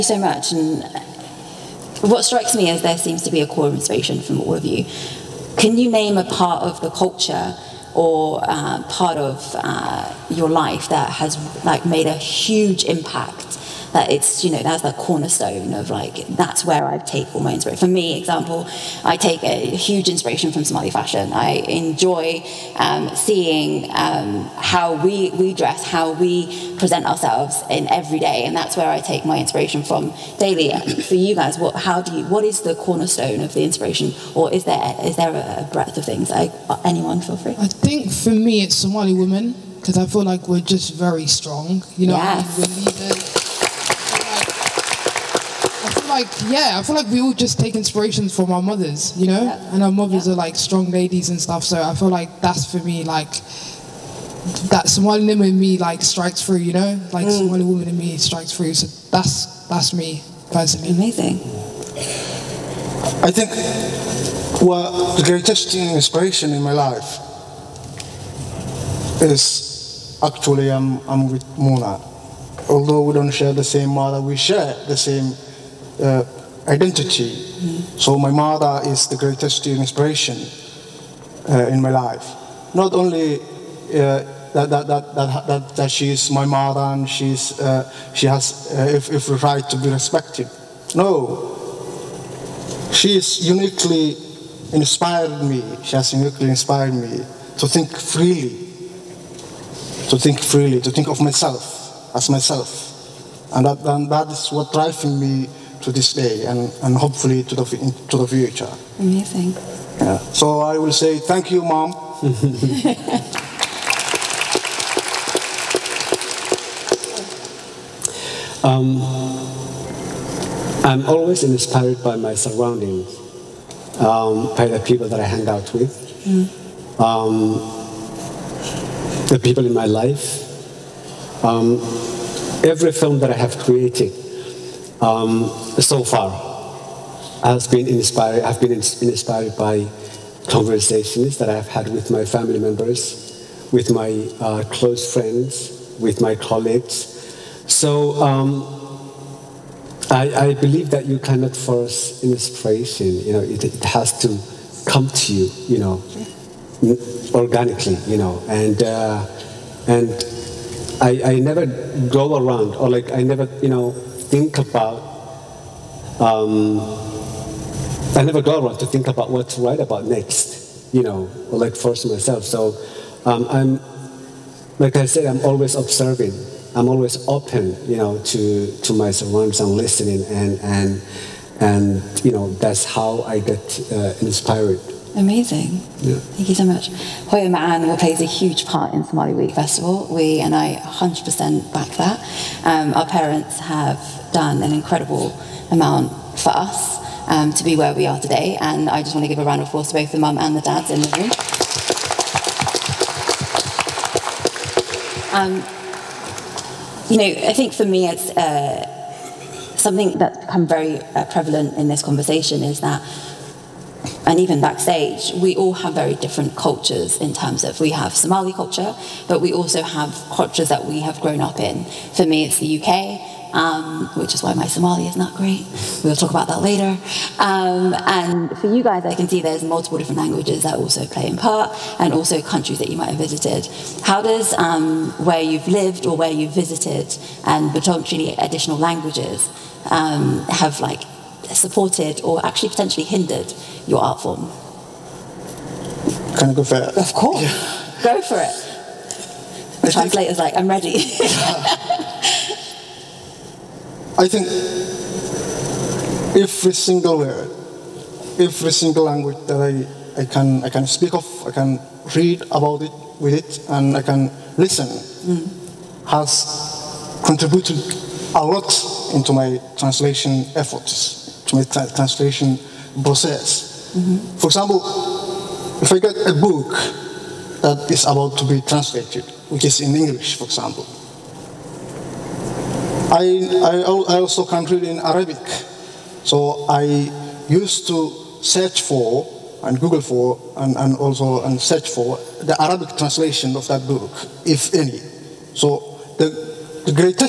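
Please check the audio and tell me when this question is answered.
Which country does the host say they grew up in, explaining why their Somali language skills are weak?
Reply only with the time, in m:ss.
3:42.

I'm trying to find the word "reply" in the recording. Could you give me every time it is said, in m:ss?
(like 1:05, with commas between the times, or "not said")
not said.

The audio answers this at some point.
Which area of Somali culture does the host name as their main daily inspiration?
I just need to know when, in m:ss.
0:20.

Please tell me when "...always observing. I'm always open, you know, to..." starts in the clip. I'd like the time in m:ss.
2:55.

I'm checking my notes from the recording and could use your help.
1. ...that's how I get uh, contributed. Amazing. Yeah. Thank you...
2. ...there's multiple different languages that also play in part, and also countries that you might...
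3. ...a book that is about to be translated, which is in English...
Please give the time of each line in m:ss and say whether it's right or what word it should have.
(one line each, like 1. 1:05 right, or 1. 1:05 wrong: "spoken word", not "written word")
1. 3:02 wrong: "inspired", not "contributed"
2. 3:49 right
3. 4:36 right.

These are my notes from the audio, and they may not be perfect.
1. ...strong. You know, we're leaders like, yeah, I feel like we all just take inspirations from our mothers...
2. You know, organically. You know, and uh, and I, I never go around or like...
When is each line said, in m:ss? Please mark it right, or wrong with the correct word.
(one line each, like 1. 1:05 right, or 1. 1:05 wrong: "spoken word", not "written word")
1. 0:41 right
2. 2:35 right.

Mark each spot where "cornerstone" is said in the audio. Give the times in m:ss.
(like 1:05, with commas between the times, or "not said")
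0:14, 0:32.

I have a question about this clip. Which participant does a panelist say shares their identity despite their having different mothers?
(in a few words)
Mona.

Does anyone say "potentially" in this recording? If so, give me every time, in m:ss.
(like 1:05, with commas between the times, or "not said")
3:57, 4:02.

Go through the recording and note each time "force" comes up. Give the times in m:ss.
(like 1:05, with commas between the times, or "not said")
2:31, 2:51.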